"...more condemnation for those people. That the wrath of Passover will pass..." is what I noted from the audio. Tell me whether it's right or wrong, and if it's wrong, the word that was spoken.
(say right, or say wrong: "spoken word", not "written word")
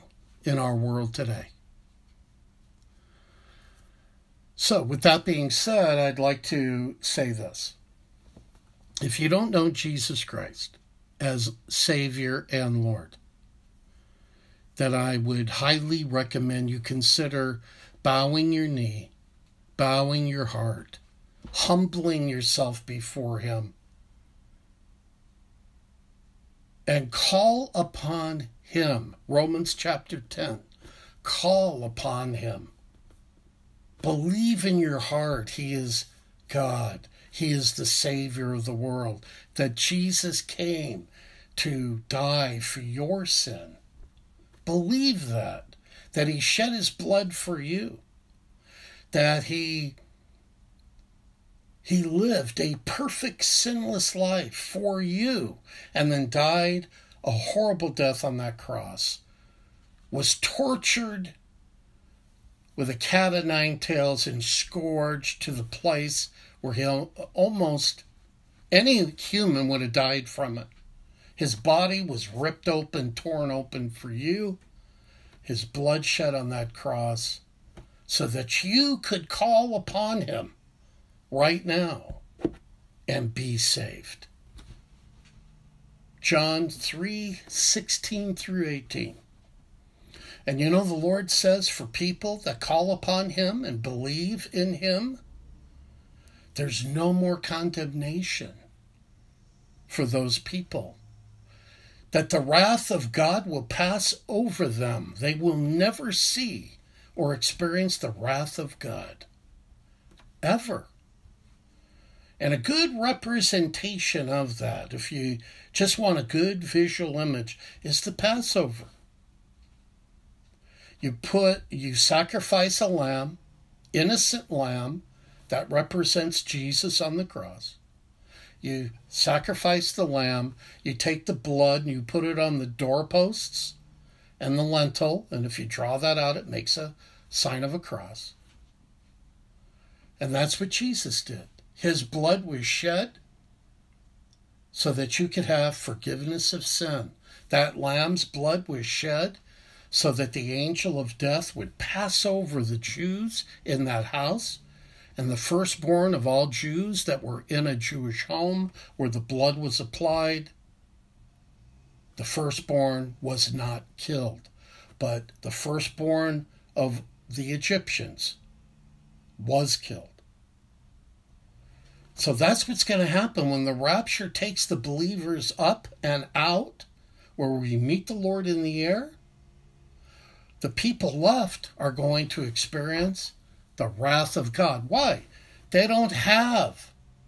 wrong: "God", not "Passover".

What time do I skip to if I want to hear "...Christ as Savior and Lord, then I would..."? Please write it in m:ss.
0:10.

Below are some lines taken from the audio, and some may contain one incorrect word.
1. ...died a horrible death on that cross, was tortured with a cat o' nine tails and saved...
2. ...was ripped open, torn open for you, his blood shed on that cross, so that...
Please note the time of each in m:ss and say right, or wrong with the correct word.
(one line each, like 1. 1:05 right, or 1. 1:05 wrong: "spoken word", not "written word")
1. 0:56 wrong: "scourged", not "saved"
2. 1:12 right.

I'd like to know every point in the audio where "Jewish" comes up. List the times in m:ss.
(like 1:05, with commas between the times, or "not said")
2:37.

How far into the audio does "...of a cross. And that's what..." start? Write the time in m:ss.
2:17.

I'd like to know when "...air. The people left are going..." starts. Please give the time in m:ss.
2:58.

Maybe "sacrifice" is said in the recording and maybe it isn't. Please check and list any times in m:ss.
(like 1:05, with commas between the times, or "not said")
2:01, 2:09.